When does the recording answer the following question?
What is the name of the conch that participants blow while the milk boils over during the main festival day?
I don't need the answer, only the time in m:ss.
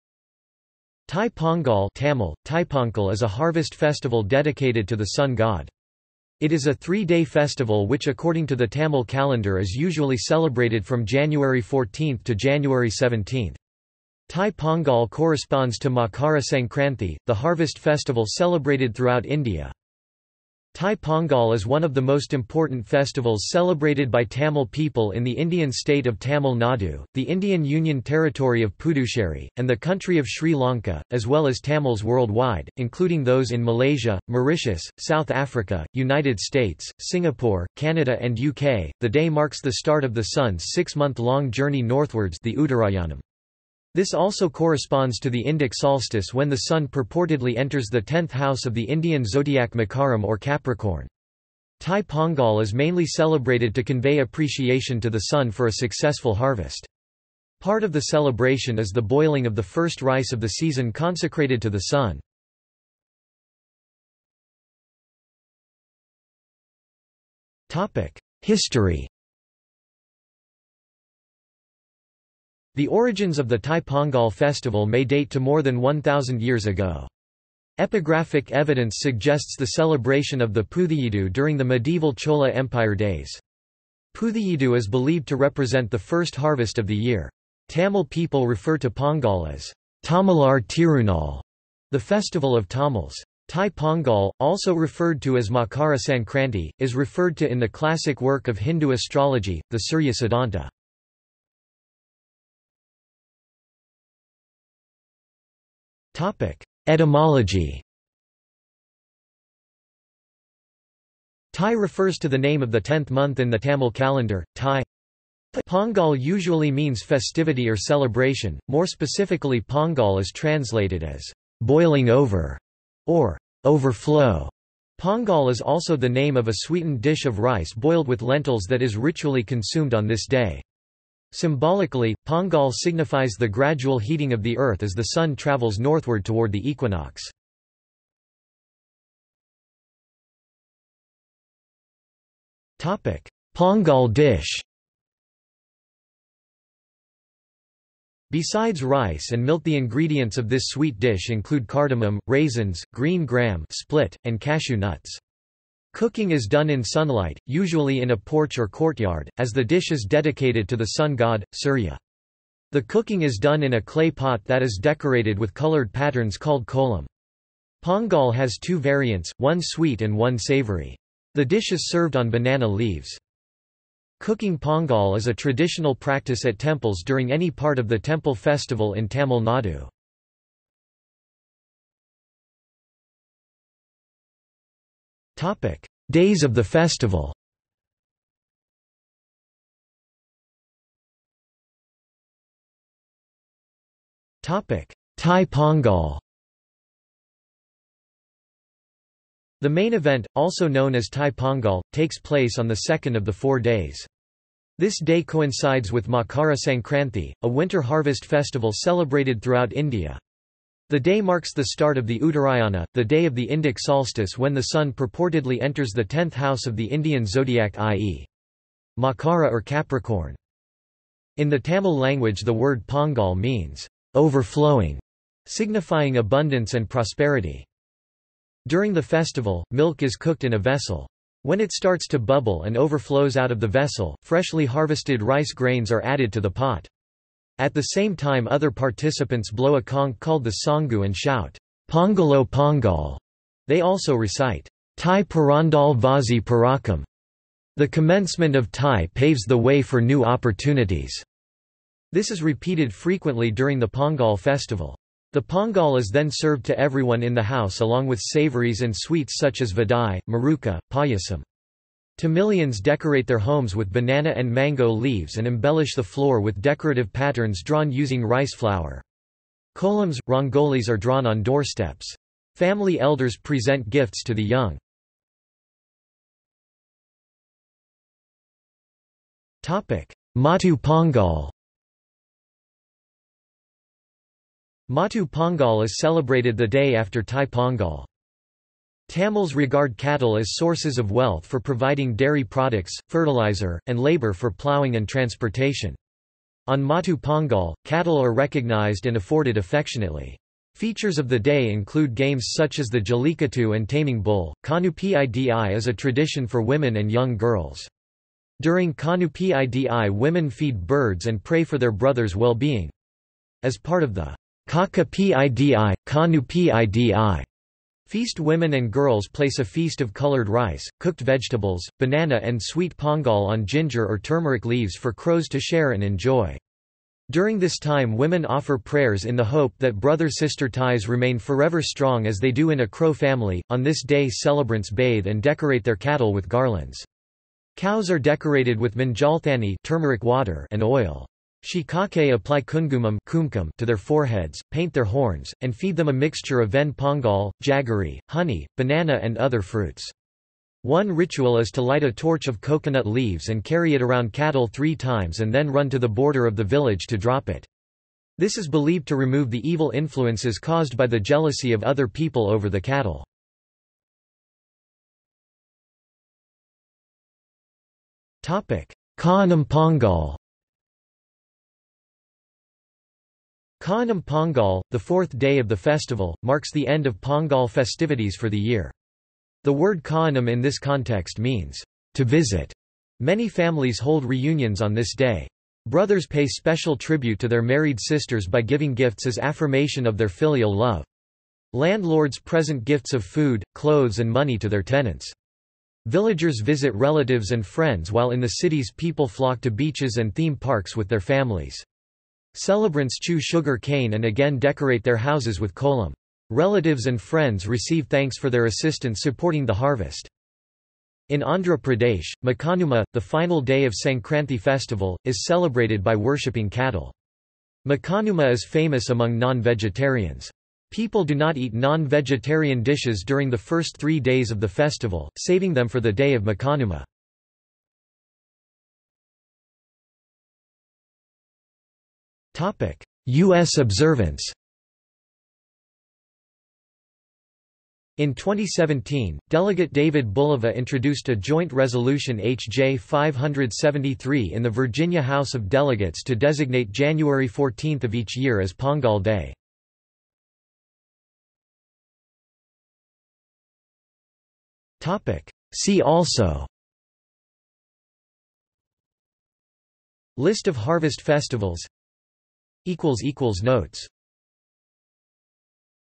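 4:00.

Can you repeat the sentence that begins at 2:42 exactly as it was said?
The cooking is done in a clay pot that is decorated with colored patterns called kolam.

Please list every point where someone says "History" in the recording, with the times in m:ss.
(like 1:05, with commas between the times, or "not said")
1:08.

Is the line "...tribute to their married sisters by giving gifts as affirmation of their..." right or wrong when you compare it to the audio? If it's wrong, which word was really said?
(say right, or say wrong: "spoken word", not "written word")
right.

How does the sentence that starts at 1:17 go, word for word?
Epigraphic evidence suggests the celebration of the Puthiyidu during the medieval Chola Empire days.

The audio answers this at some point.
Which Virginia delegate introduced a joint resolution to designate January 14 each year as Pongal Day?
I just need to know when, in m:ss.
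7:19.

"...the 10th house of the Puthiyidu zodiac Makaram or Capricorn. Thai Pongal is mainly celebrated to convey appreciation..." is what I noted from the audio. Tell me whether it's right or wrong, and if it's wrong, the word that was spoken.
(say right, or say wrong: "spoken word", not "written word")
wrong: "Indian", not "Puthiyidu".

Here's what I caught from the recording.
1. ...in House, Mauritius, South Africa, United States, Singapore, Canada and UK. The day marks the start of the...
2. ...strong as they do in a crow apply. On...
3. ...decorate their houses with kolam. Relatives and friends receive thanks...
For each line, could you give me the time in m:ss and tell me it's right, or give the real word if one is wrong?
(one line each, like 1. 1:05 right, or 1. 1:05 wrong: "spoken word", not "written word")
1. 0:33 wrong: "Malaysia", not "House"
2. 5:31 wrong: "family", not "apply"
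3. 6:44 right.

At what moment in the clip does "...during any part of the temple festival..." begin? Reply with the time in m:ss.
2:57.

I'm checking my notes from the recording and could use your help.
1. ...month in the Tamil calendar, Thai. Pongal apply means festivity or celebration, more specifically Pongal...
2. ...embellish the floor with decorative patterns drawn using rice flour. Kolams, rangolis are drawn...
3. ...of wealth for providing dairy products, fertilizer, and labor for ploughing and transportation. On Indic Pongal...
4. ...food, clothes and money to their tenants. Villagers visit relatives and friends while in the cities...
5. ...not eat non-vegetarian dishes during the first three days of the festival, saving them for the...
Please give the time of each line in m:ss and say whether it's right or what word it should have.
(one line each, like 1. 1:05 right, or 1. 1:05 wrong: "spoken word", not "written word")
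1. 1:53 wrong: "usually", not "apply"
2. 4:25 right
3. 4:50 wrong: "Maatu", not "Indic"
4. 6:33 right
5. 7:01 right.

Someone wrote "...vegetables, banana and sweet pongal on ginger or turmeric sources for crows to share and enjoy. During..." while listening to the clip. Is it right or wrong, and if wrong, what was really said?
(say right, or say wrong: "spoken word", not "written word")
wrong: "leaves", not "sources".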